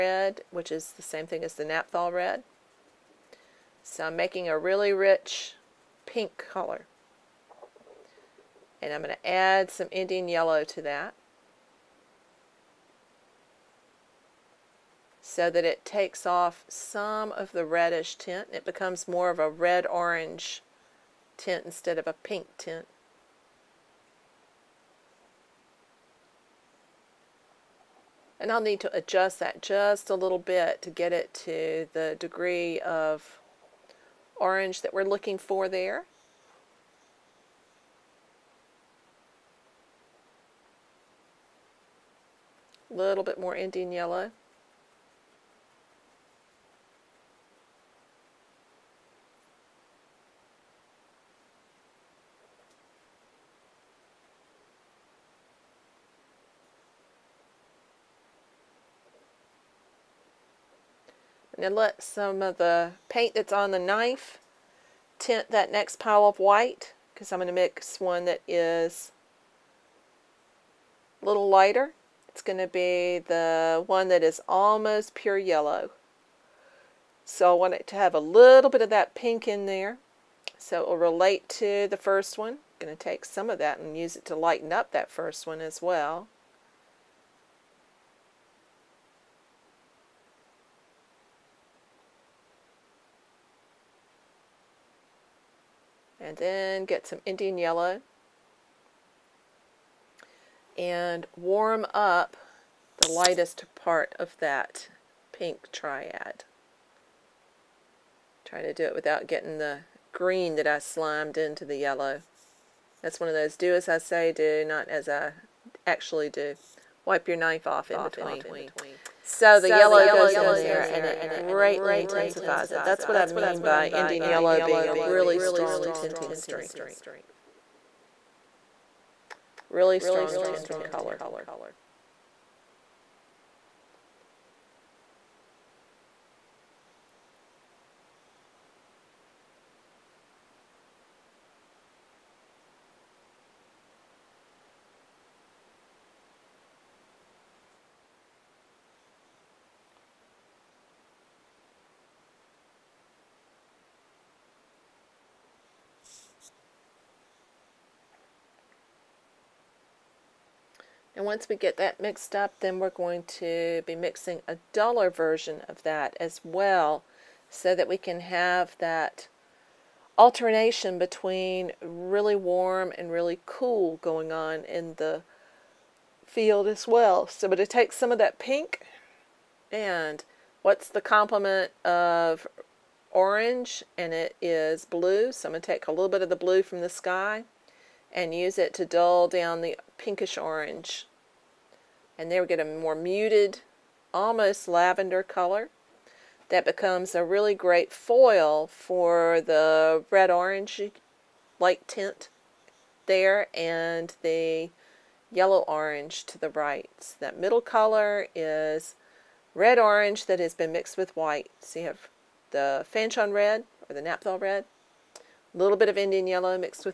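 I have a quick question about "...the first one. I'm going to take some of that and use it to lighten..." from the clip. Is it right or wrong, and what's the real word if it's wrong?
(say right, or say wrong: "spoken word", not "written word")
right.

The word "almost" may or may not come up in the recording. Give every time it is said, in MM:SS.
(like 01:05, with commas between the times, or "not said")
01:14, 03:14.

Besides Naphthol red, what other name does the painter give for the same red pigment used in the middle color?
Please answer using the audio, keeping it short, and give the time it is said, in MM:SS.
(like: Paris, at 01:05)
Fanchon red, at 03:32.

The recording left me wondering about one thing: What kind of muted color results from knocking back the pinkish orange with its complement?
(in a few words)
lavender.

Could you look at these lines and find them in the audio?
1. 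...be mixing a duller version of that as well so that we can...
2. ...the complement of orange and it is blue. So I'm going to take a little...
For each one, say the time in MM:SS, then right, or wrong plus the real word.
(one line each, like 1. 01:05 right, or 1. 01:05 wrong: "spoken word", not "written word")
1. 02:43 right
2. 03:00 right.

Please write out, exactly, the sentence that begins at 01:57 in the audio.
Wipe your knife off in between.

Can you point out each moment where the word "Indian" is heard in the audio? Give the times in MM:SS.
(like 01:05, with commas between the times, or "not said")
00:09, 00:43, 01:37, 02:03, 03:35.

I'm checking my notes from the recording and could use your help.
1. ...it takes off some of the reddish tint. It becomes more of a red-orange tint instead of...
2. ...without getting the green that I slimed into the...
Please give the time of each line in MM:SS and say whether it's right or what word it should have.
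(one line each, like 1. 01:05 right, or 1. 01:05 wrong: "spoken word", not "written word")
1. 00:15 right
2. 01:48 right.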